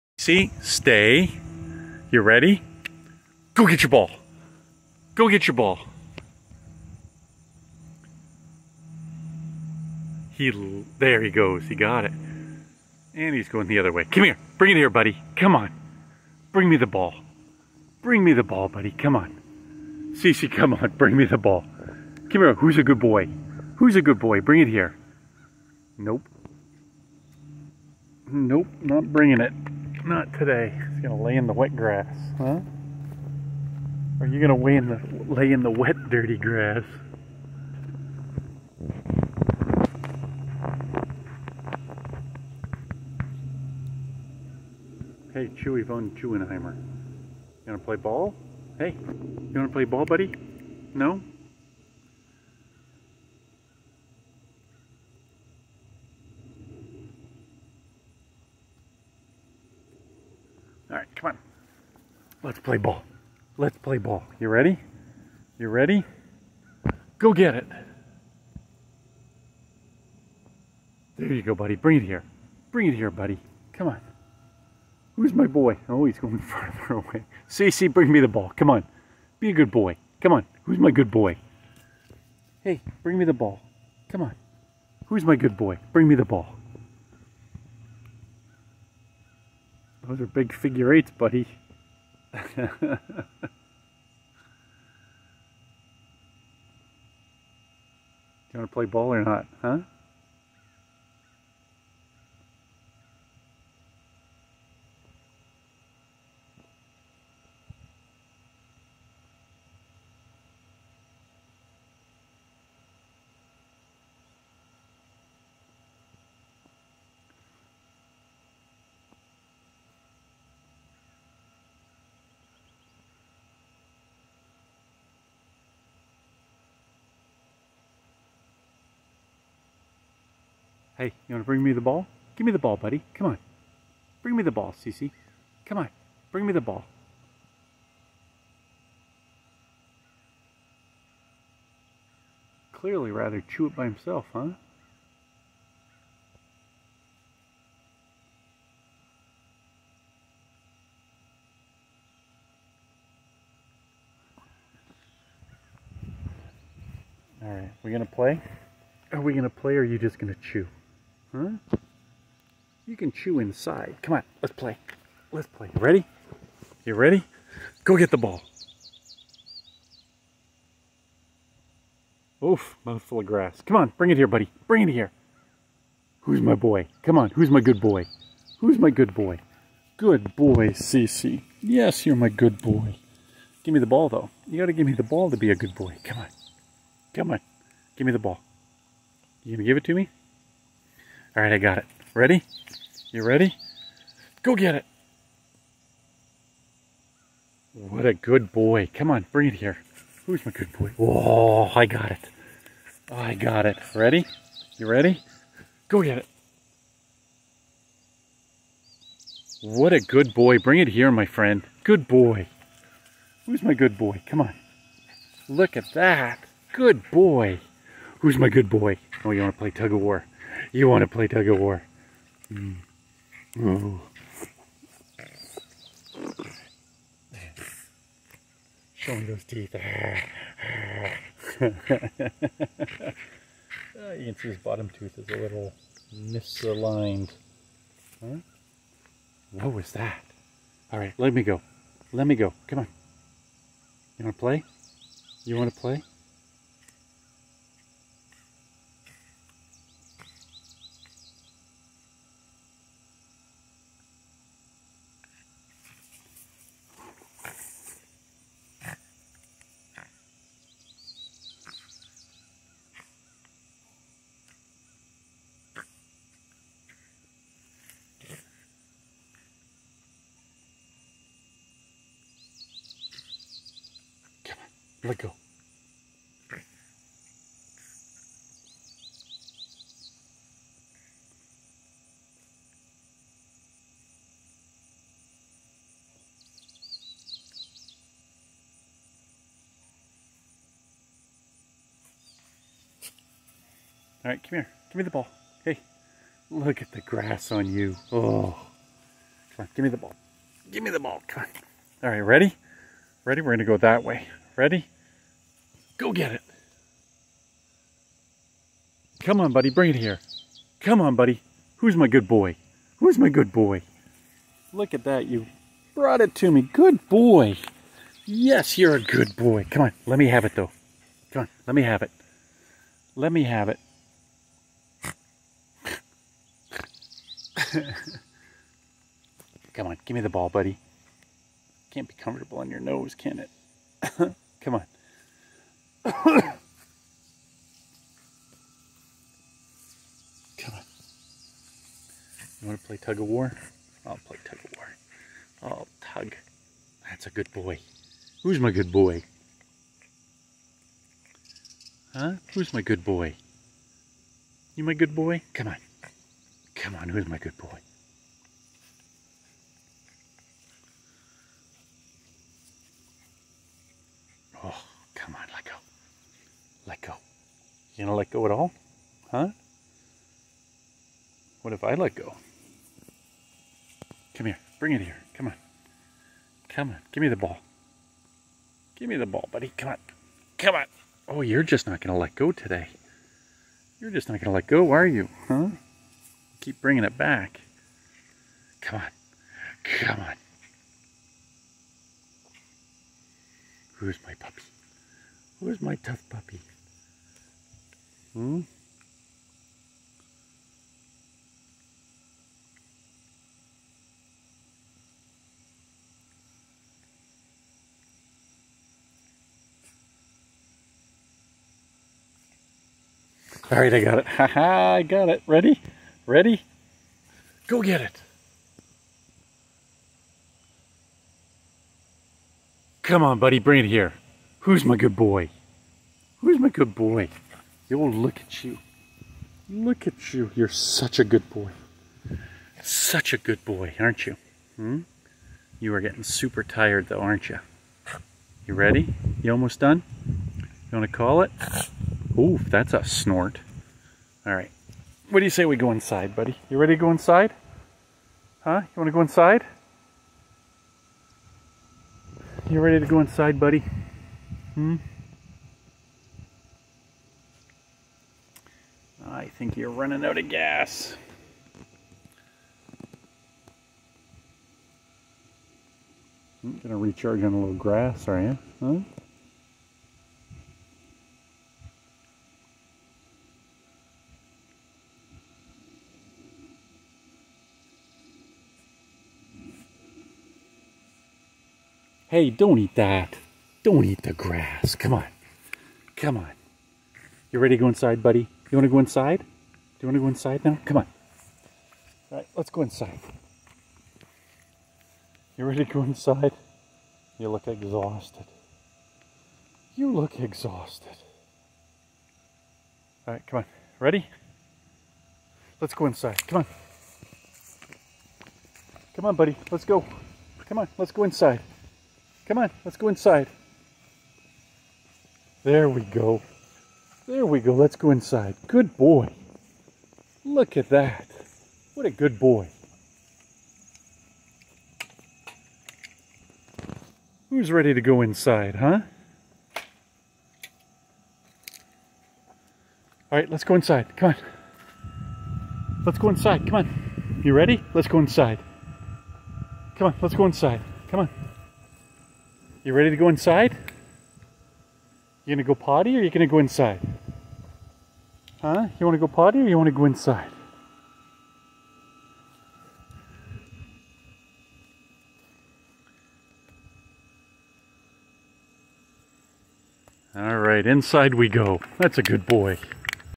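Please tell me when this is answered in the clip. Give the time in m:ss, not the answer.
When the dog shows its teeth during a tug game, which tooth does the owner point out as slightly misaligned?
3:54.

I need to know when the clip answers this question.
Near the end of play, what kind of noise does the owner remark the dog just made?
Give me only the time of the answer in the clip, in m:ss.
7:23.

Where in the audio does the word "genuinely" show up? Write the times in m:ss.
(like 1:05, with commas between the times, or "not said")
not said.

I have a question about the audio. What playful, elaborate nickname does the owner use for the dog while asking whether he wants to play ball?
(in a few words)
Chewy von Chewenheimer.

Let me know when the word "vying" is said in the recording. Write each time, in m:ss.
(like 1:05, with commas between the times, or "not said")
not said.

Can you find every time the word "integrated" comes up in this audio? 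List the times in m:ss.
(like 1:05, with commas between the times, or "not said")
not said.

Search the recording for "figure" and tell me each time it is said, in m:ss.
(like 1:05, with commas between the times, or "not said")
1:30.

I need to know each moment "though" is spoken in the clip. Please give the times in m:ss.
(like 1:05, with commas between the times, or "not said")
3:04, 5:20, 7:17.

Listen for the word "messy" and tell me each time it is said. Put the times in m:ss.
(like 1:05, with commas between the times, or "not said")
not said.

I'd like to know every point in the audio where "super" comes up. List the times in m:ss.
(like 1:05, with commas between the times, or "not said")
7:16.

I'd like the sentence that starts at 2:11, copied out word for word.
Hey, you want to bring me the ball?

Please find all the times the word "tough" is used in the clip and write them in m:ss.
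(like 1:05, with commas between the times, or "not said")
6:35.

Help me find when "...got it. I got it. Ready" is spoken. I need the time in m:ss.
3:21.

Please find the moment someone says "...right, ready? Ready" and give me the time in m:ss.
5:02.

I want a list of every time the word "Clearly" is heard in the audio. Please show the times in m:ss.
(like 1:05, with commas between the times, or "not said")
2:22.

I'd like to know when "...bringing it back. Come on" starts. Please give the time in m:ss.
6:26.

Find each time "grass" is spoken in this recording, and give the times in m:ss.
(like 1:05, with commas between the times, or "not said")
0:31, 0:36, 2:53, 4:57, 7:47, 8:04.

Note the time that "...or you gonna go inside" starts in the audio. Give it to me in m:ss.
9:06.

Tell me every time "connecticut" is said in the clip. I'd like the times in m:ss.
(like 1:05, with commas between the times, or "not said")
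not said.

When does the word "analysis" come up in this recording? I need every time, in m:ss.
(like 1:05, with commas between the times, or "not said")
not said.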